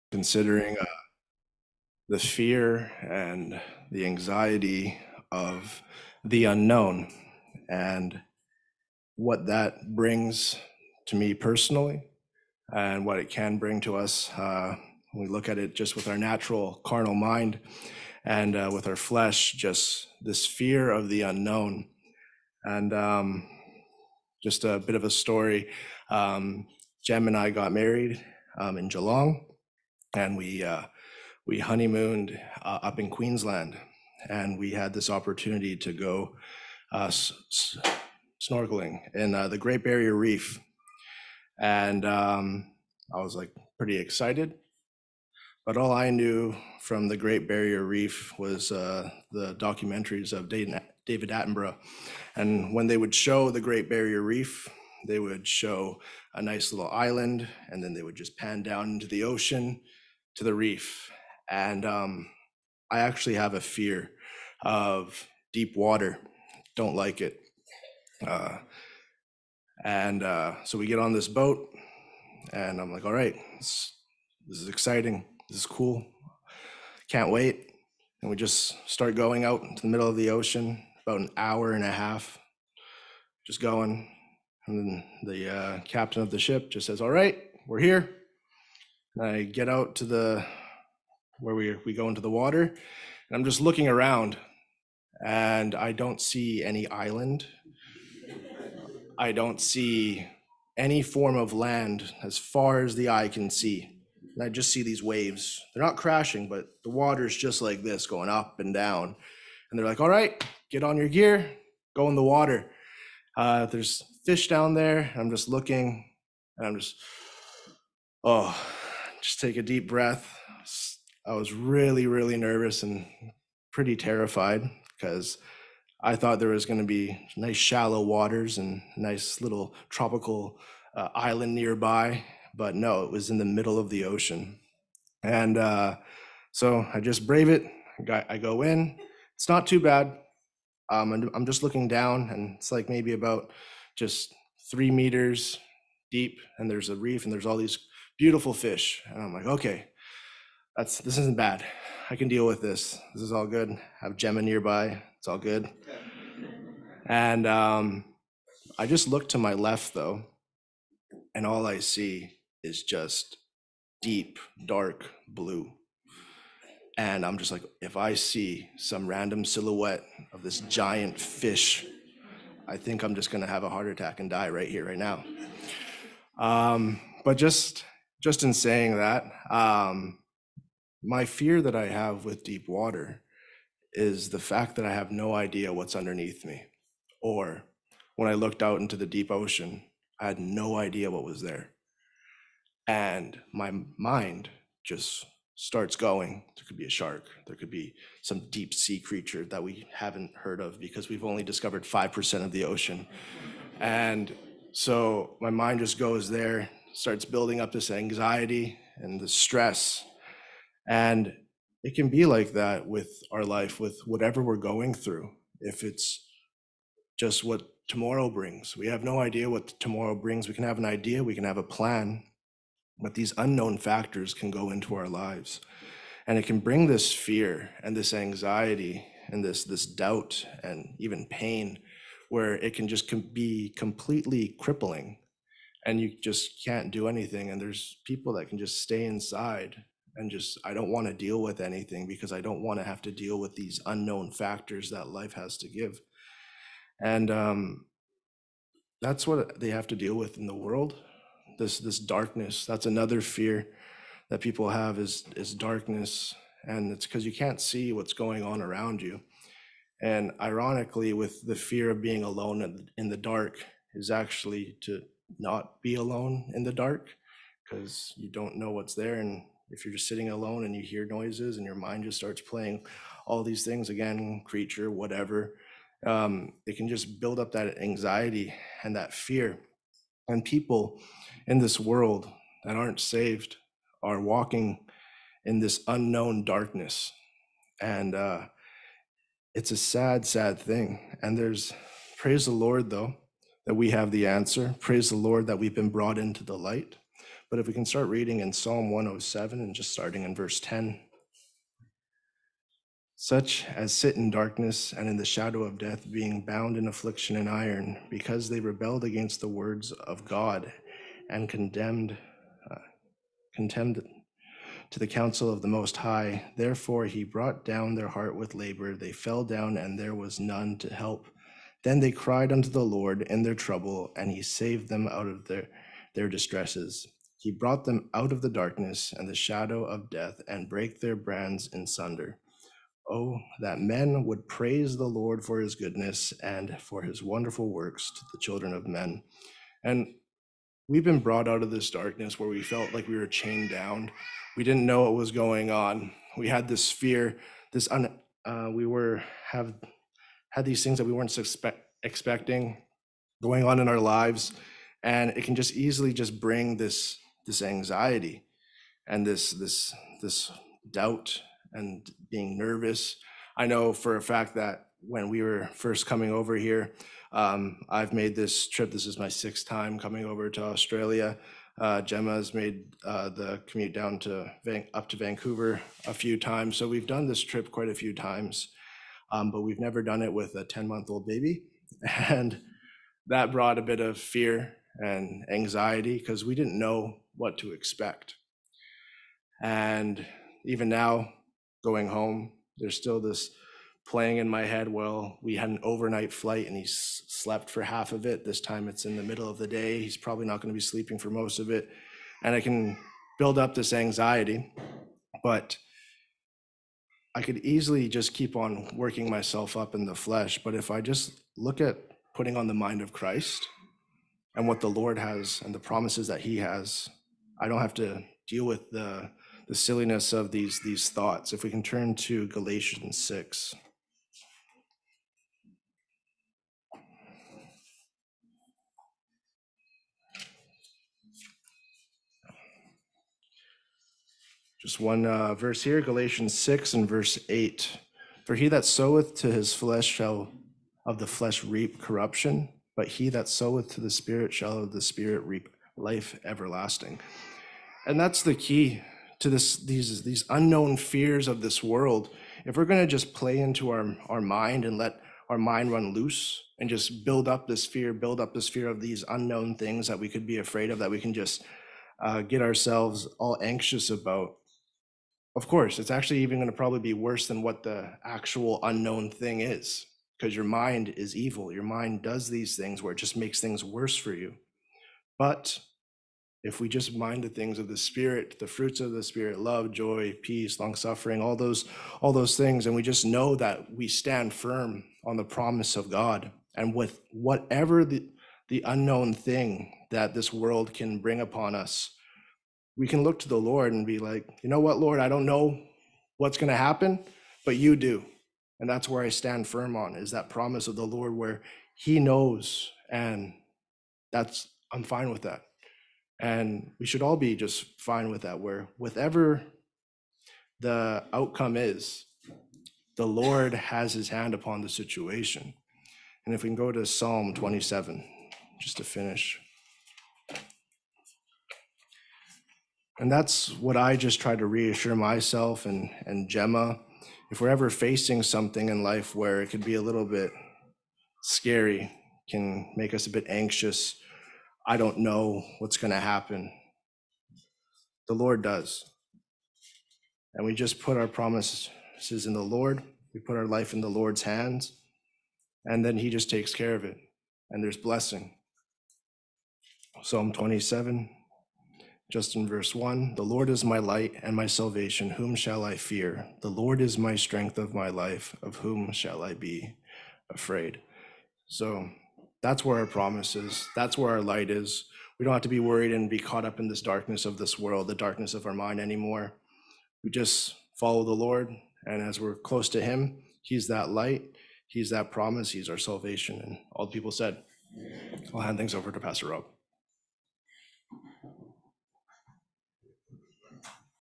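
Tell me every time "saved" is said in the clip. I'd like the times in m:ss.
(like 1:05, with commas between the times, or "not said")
4:42, 5:24.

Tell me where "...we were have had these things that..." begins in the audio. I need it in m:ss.
5:48.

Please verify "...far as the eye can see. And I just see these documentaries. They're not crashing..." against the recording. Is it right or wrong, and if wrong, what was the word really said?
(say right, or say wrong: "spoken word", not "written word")
wrong: "waves", not "documentaries".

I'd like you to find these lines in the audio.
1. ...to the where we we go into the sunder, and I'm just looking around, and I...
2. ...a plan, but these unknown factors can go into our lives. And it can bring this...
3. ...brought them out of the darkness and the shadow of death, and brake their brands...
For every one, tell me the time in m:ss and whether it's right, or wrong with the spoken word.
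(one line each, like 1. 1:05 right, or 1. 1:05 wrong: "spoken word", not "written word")
1. 1:29 wrong: "water", not "sunder"
2. 3:41 right
3. 5:27 right.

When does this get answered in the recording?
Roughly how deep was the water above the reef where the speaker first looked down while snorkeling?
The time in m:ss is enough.
2:24.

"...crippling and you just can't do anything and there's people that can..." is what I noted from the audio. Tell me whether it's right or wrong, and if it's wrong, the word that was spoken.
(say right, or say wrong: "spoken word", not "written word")
right.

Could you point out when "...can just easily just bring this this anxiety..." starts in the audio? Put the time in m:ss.
5:55.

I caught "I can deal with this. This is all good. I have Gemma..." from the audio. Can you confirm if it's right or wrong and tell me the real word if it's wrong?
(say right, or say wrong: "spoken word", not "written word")
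right.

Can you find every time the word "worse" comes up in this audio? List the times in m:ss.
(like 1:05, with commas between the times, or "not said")
7:47, 7:53.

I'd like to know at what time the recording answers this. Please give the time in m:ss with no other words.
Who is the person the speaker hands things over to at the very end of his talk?
9:39.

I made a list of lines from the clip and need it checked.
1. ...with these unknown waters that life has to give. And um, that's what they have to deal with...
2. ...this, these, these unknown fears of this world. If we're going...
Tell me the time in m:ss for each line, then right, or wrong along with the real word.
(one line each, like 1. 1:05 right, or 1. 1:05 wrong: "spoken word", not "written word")
1. 4:03 wrong: "factors", not "waters"
2. 7:29 right.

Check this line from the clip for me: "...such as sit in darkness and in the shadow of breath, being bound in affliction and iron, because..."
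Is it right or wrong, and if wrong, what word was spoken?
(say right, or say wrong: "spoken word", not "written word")
wrong: "death", not "breath".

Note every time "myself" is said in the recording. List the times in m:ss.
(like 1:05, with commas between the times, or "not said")
6:49, 8:45.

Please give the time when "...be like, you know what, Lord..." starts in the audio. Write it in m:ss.
8:14.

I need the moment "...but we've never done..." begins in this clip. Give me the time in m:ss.
6:19.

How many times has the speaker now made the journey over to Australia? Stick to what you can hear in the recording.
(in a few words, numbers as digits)
6.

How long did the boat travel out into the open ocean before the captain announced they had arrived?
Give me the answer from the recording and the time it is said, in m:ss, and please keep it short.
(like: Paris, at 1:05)
an hour and a half, at 1:21.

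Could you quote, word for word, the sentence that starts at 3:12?
And my mind just starts going.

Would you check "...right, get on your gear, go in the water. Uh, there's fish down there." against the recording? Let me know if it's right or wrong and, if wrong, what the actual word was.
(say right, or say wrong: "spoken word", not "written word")
right.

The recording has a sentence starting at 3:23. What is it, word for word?
And so my mind just goes there starts building up this anxiety and the stress.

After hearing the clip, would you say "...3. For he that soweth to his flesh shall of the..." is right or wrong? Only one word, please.
wrong.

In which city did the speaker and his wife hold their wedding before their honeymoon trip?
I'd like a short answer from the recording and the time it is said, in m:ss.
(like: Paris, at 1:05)
Geelong, at 0:28.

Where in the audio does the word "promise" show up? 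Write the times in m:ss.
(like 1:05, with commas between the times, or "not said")
6:55, 8:05, 8:20, 9:01, 9:23, 9:35.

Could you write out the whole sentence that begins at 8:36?
And if we can go to Psalm 27 just to finish.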